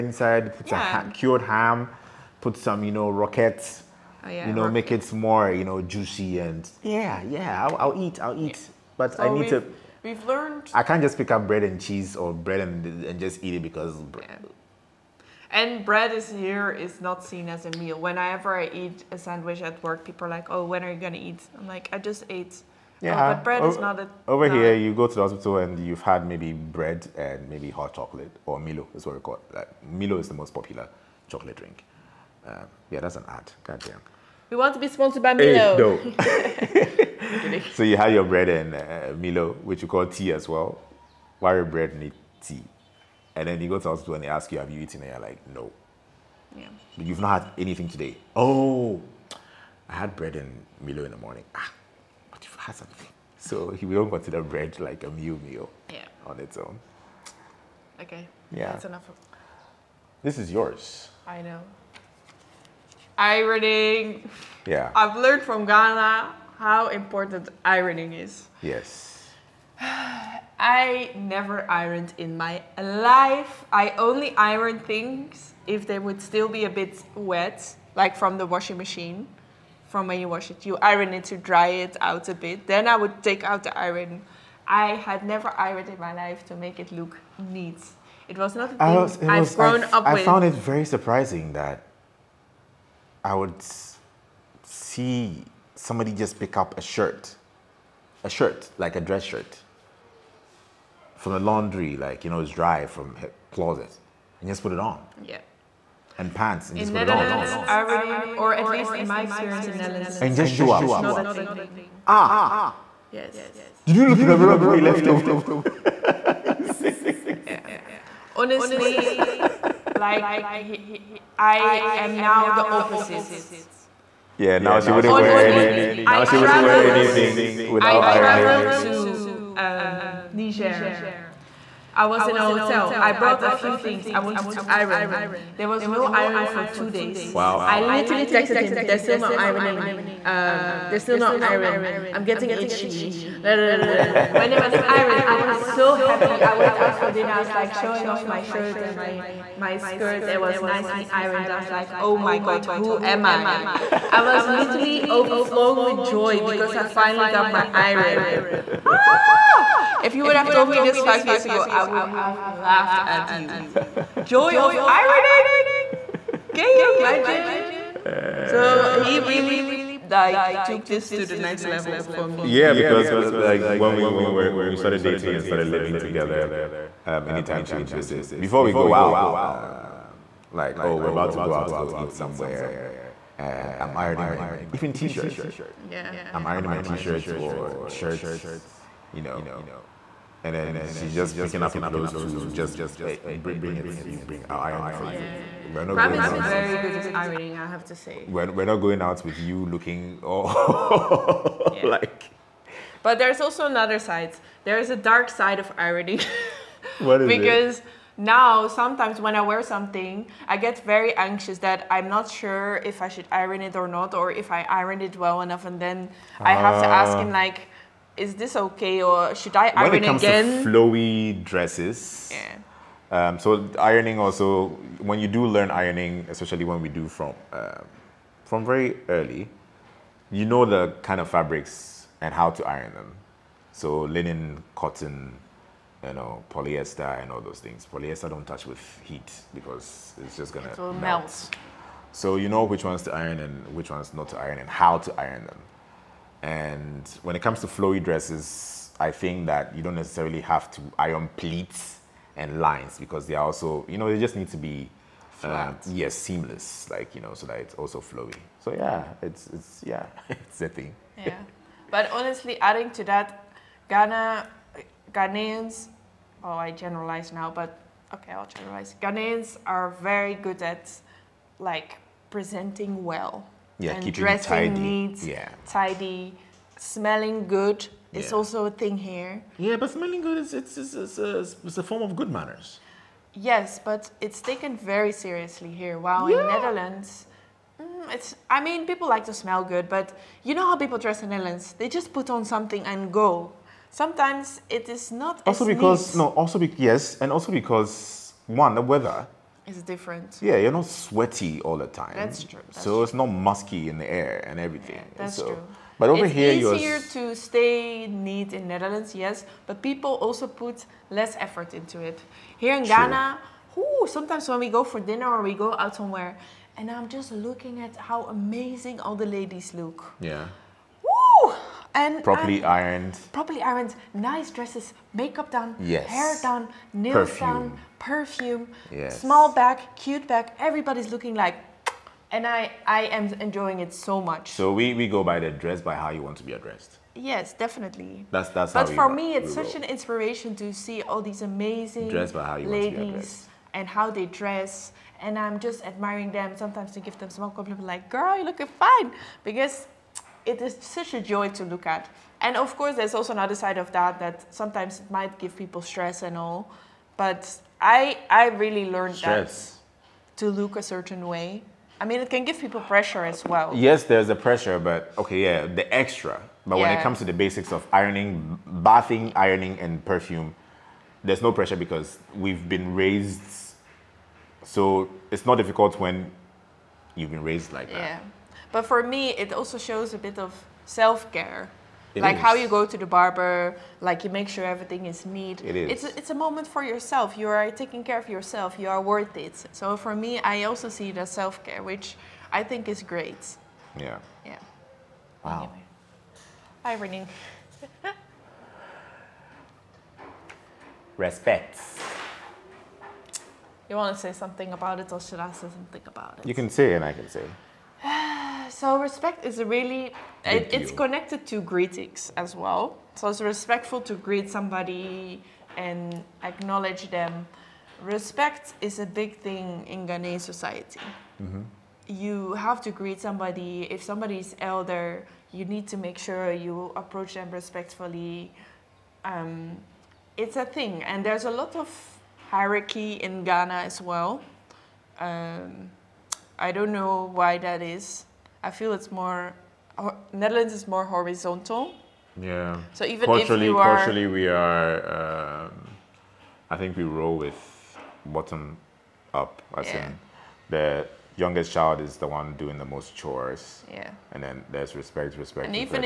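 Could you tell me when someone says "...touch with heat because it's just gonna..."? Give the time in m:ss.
3:58.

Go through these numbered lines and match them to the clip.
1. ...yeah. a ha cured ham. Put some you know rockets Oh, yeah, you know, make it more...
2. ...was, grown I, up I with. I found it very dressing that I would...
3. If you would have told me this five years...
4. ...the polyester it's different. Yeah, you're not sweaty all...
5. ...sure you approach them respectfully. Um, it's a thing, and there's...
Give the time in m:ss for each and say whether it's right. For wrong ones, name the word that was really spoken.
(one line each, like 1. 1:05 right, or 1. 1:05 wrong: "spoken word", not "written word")
1. 0:00 right
2. 1:29 wrong: "surprising", not "dressing"
3. 2:40 right
4. 4:58 wrong: "weather", not "polyester"
5. 7:06 right.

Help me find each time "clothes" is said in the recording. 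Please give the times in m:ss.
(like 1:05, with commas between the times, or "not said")
3:11.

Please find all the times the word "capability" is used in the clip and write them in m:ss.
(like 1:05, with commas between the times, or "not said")
not said.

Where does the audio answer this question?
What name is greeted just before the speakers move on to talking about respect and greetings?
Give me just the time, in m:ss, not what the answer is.
6:37.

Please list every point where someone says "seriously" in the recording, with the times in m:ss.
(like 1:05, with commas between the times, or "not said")
4:45.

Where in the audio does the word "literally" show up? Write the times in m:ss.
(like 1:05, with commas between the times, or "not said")
2:17, 2:34.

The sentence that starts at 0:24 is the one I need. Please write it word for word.
Over here, you go to the hospital and you've had maybe bread and maybe hot chocolate or Milo is what we call.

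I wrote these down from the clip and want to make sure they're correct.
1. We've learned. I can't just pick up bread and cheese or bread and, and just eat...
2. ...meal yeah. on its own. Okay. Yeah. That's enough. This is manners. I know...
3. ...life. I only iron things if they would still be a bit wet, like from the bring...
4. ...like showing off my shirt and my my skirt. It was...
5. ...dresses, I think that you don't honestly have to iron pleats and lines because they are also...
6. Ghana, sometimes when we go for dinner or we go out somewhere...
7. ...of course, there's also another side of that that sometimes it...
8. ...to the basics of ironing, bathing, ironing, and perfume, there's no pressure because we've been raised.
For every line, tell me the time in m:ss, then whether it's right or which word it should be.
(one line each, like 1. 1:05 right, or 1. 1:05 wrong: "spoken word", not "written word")
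1. 0:10 right
2. 0:55 wrong: "yours", not "manners"
3. 1:12 wrong: "washing", not "bring"
4. 2:27 right
5. 4:08 wrong: "necessarily", not "honestly"
6. 5:12 right
7. 5:52 right
8. 6:07 right.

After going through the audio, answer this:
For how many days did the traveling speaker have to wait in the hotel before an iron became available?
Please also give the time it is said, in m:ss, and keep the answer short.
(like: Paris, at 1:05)
2, at 2:16.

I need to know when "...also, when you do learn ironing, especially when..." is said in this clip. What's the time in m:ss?
3:44.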